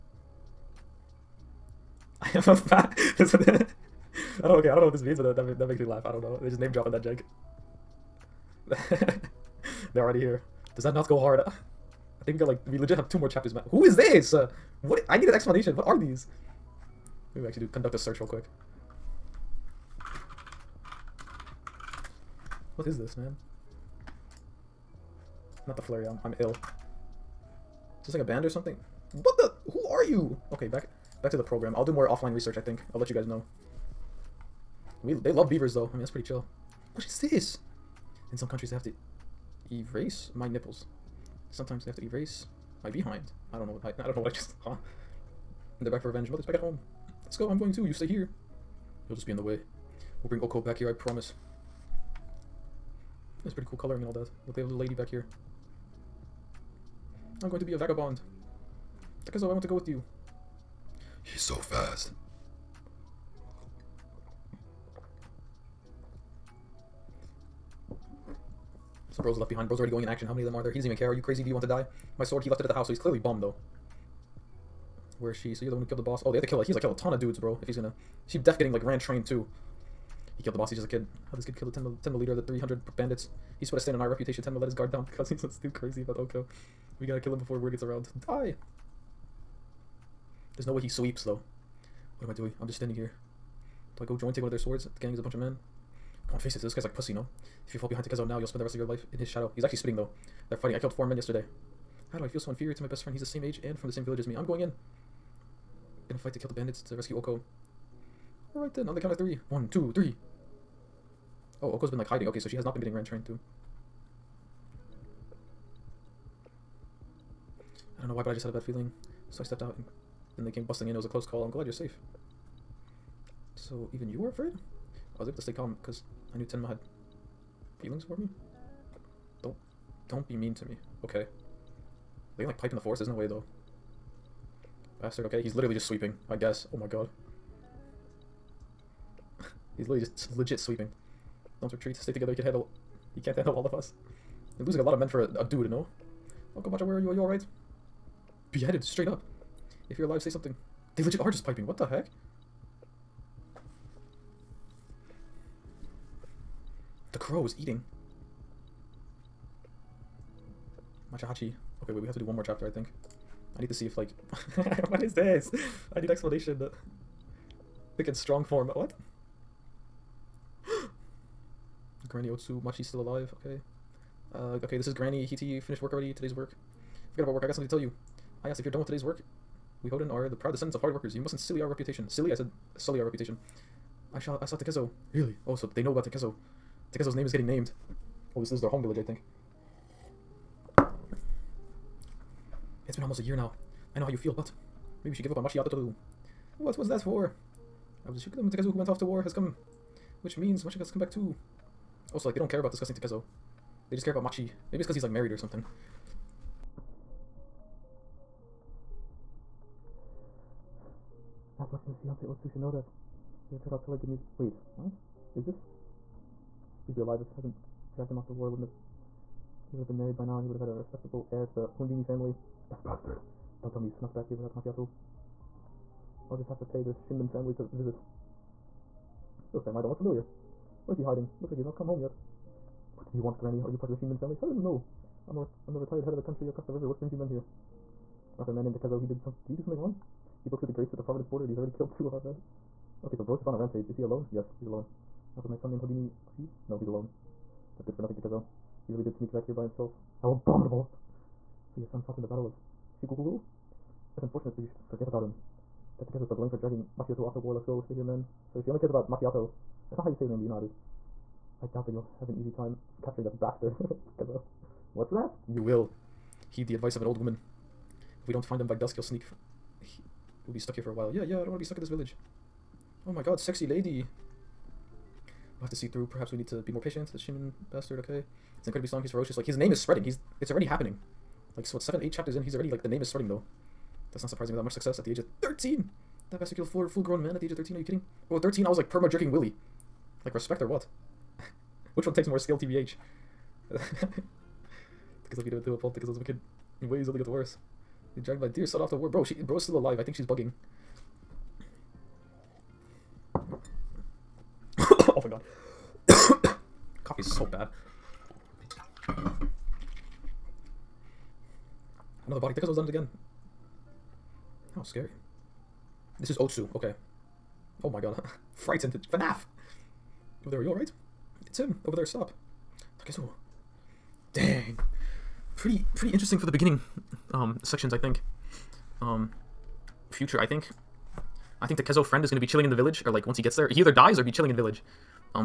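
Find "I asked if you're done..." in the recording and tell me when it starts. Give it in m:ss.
2:58.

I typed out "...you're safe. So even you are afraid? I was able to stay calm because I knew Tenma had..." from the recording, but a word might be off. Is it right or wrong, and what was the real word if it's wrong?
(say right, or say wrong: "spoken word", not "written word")
right.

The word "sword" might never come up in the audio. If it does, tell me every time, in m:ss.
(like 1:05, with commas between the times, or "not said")
1:12, 1:34.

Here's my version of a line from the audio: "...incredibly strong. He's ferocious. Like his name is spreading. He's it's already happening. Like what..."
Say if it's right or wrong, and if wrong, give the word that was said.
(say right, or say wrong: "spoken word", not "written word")
right.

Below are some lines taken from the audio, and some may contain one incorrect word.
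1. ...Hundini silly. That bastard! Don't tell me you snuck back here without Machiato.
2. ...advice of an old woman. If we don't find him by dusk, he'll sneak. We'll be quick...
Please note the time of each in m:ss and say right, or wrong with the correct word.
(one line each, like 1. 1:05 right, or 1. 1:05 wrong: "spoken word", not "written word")
1. 3:41 wrong: "family", not "silly"
2. 4:26 wrong: "stuck", not "quick".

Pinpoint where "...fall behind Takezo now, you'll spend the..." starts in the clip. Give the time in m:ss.
1:37.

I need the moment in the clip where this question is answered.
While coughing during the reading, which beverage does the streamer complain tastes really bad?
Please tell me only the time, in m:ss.
5:07.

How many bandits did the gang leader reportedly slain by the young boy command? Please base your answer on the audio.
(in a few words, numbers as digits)
300.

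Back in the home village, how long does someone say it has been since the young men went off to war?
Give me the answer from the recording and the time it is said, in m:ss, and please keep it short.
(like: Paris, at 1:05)
almost a year, at 3:13.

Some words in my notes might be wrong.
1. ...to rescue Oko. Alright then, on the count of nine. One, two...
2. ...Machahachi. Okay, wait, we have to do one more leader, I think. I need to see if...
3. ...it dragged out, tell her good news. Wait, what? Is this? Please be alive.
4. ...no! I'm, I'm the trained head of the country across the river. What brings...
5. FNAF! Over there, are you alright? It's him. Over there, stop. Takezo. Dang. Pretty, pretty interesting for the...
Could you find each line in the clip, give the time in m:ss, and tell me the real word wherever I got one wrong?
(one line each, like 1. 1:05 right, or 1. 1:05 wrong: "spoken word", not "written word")
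1. 1:46 wrong: "three", not "nine"
2. 2:41 wrong: "chapter", not "leader"
3. 3:33 wrong: "turned", not "dragged"
4. 3:54 wrong: "retired", not "trained"
5. 5:19 right.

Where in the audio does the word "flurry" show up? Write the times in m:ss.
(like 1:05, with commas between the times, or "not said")
0:25.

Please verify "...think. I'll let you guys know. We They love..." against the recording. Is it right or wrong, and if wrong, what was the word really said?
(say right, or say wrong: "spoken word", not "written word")
right.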